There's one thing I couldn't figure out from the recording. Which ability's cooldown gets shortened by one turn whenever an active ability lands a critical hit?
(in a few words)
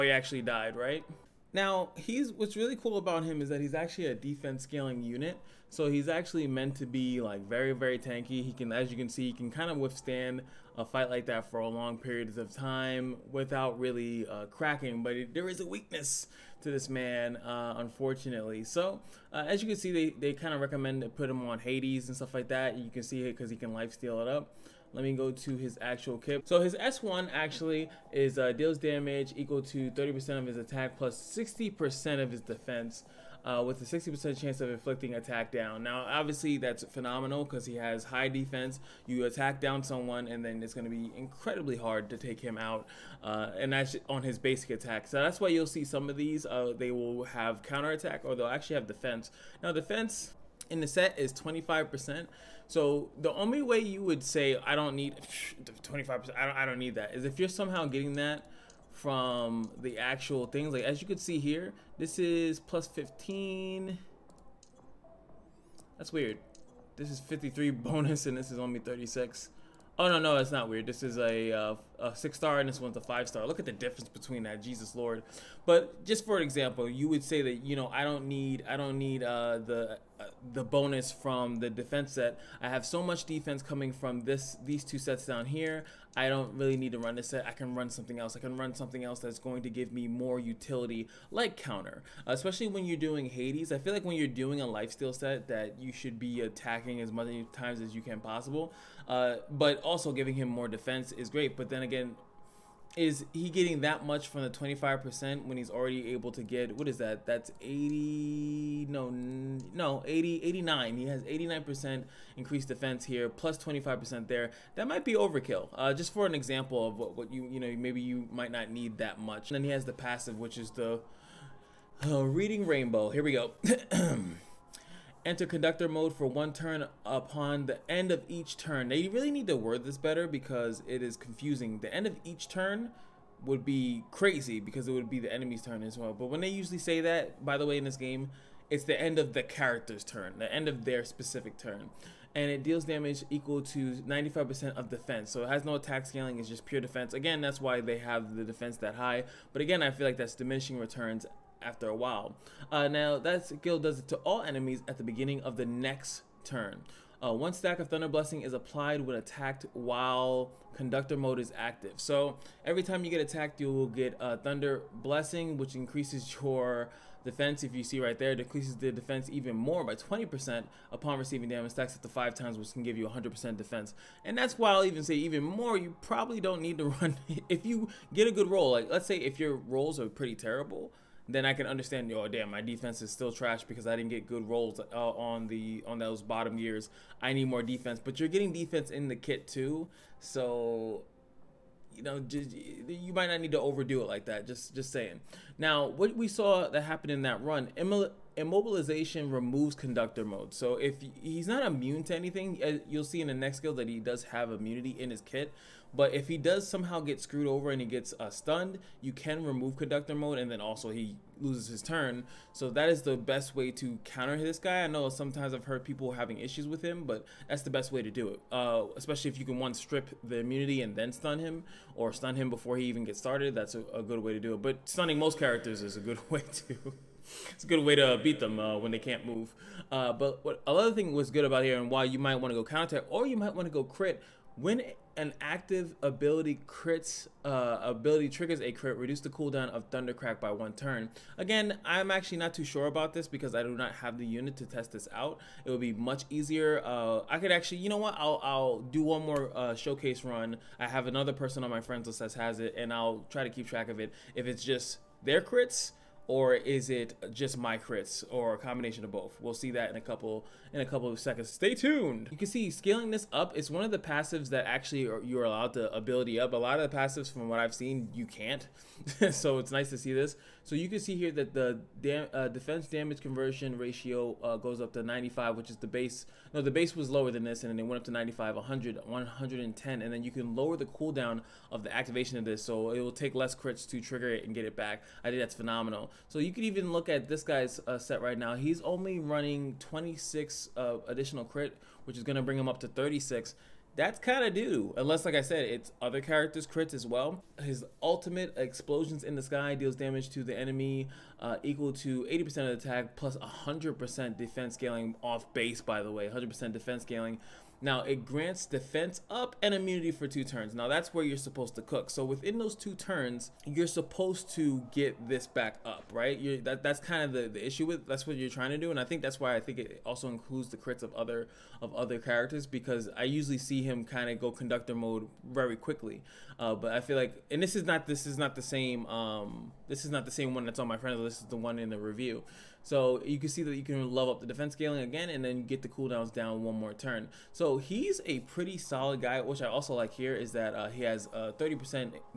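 Thundercrack.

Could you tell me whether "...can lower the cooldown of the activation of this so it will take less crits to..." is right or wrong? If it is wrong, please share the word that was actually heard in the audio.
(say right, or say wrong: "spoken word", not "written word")
right.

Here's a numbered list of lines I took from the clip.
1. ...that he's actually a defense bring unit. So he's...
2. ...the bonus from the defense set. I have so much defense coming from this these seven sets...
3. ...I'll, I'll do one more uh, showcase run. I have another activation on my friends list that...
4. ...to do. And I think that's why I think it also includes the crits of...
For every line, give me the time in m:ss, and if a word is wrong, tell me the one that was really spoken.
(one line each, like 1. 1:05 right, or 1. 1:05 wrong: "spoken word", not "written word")
1. 0:03 wrong: "scaling", not "bring"
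2. 1:20 wrong: "two", not "seven"
3. 4:08 wrong: "person", not "activation"
4. 5:18 right.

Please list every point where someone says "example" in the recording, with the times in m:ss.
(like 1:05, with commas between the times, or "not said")
1:16, 1:56.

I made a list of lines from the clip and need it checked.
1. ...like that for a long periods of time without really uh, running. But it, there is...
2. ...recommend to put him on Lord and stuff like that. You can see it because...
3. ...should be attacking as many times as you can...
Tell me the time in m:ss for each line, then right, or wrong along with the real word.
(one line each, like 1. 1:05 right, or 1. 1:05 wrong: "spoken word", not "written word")
1. 0:11 wrong: "cracking", not "running"
2. 0:20 wrong: "Hades", not "Lord"
3. 1:35 right.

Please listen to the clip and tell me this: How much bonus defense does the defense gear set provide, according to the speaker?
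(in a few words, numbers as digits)
25%.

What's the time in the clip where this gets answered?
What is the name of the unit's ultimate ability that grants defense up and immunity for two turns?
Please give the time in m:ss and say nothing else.
4:58.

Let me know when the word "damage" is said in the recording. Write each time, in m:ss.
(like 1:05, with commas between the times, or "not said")
0:28, 2:22, 2:51, 4:32, 4:59.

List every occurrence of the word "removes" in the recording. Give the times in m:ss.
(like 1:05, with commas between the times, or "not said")
3:19, 3:29.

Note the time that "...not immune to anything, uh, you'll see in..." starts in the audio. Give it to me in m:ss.
3:21.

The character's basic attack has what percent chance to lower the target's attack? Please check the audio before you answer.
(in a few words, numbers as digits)
60%.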